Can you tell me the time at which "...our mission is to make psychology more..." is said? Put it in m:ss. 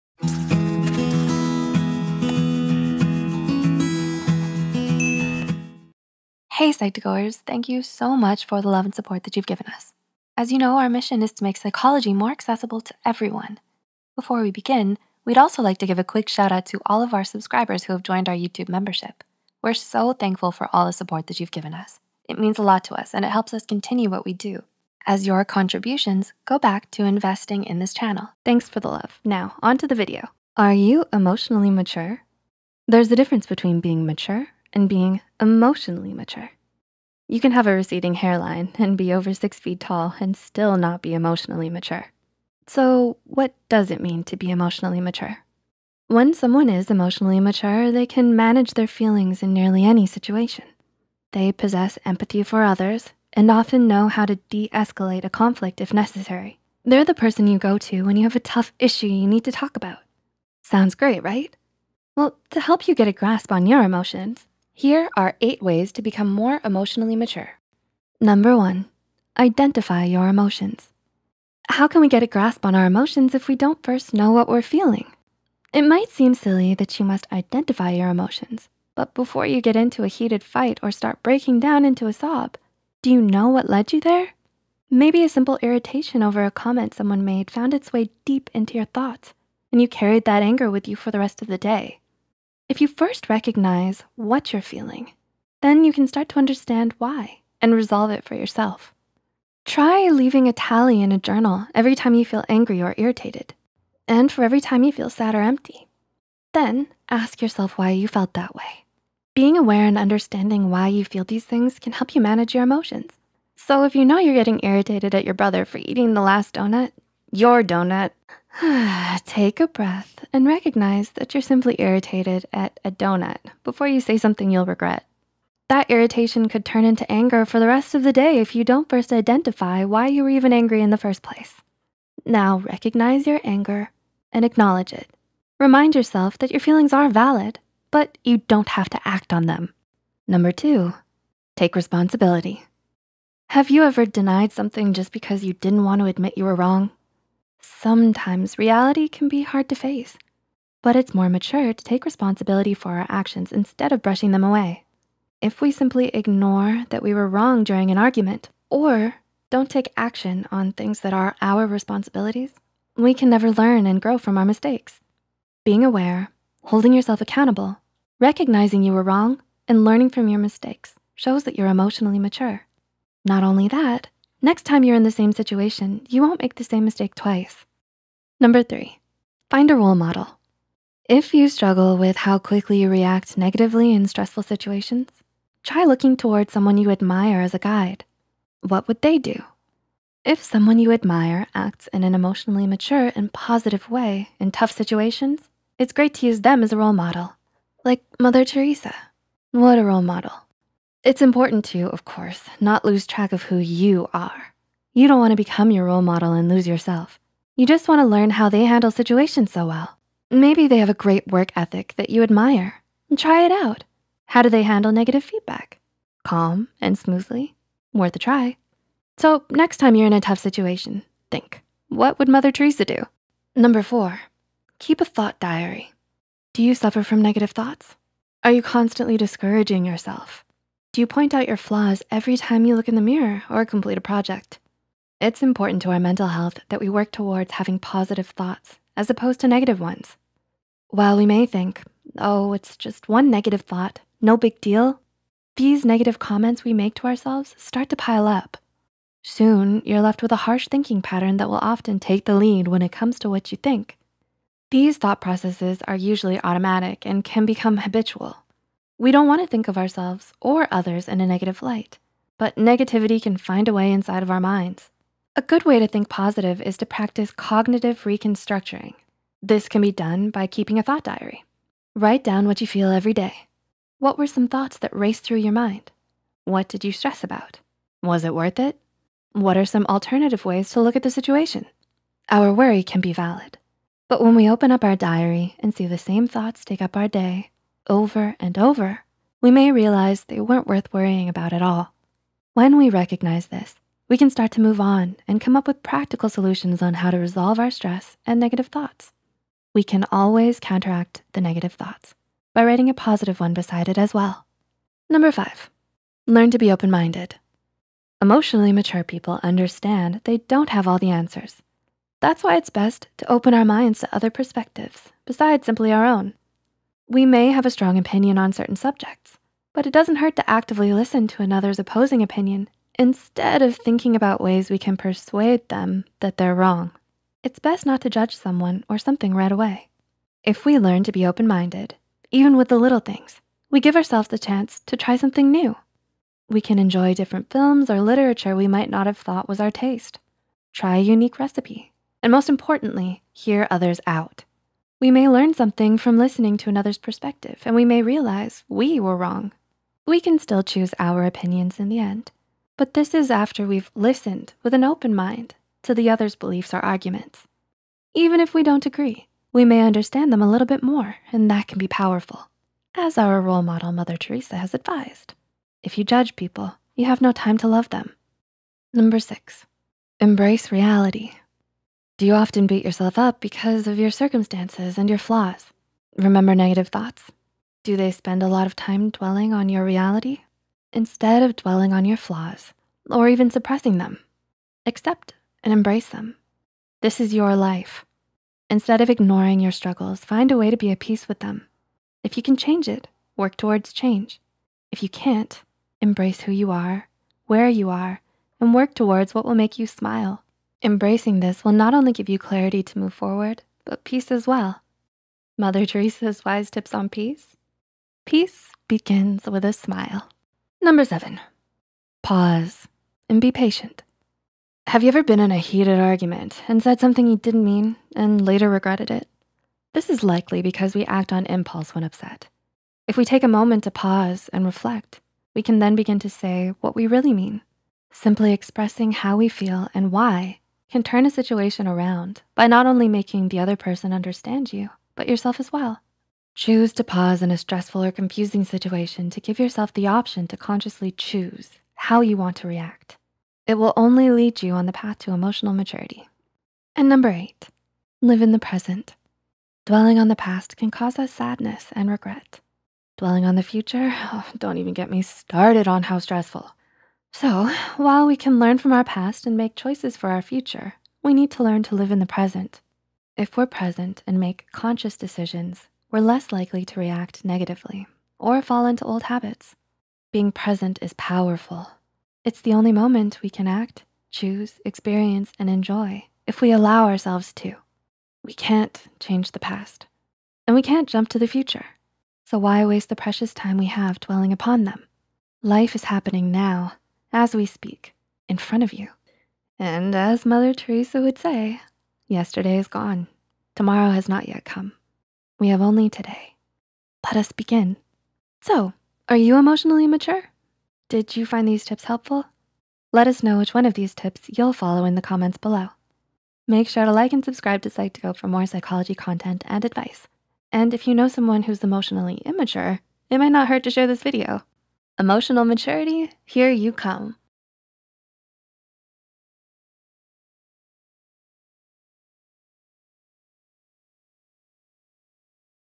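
0:10.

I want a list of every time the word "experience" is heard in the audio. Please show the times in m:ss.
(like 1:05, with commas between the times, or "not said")
7:54.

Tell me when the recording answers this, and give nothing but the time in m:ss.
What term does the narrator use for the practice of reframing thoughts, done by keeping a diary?
4:27.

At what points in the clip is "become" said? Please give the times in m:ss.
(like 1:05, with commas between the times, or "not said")
1:06, 3:25, 4:17.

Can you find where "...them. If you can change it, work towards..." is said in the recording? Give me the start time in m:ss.
6:31.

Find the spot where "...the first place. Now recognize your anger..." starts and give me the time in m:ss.
2:10.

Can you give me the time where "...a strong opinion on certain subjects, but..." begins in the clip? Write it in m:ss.
5:17.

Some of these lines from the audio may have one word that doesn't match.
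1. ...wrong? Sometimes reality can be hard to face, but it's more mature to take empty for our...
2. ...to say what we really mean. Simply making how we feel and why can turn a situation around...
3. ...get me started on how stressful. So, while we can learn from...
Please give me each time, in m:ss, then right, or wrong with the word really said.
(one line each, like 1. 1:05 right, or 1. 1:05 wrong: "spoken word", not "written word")
1. 2:26 wrong: "responsibility", not "empty"
2. 7:06 wrong: "expressing", not "making"
3. 7:34 right.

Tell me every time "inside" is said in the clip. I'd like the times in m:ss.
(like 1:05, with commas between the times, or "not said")
4:23.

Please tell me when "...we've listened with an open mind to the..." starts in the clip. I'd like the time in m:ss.
5:53.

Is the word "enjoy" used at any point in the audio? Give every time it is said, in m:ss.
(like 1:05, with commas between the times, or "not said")
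5:36, 7:55.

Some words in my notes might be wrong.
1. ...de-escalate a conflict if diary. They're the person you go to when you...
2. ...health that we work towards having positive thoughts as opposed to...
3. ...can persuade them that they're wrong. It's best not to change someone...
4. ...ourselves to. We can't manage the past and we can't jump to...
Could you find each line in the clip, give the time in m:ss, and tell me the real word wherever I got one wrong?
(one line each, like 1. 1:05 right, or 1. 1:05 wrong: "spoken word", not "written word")
1. 0:54 wrong: "necessary", not "diary"
2. 3:56 right
3. 5:24 wrong: "judge", not "change"
4. 7:57 wrong: "change", not "manage".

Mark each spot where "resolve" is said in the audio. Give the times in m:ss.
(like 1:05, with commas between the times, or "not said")
1:37, 4:57.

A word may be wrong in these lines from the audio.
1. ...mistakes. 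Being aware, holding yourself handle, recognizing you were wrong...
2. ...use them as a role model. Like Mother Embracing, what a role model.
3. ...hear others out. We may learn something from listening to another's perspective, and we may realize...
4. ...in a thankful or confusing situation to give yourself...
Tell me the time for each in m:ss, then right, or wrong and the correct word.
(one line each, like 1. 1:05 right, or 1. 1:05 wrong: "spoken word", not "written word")
1. 2:44 wrong: "accountable", not "handle"
2. 3:16 wrong: "Teresa", not "Embracing"
3. 5:43 right
4. 7:17 wrong: "stressful", not "thankful".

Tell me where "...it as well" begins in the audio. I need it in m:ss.
5:03.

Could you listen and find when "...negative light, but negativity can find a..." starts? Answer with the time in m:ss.
4:21.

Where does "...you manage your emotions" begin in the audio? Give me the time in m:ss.
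1:52.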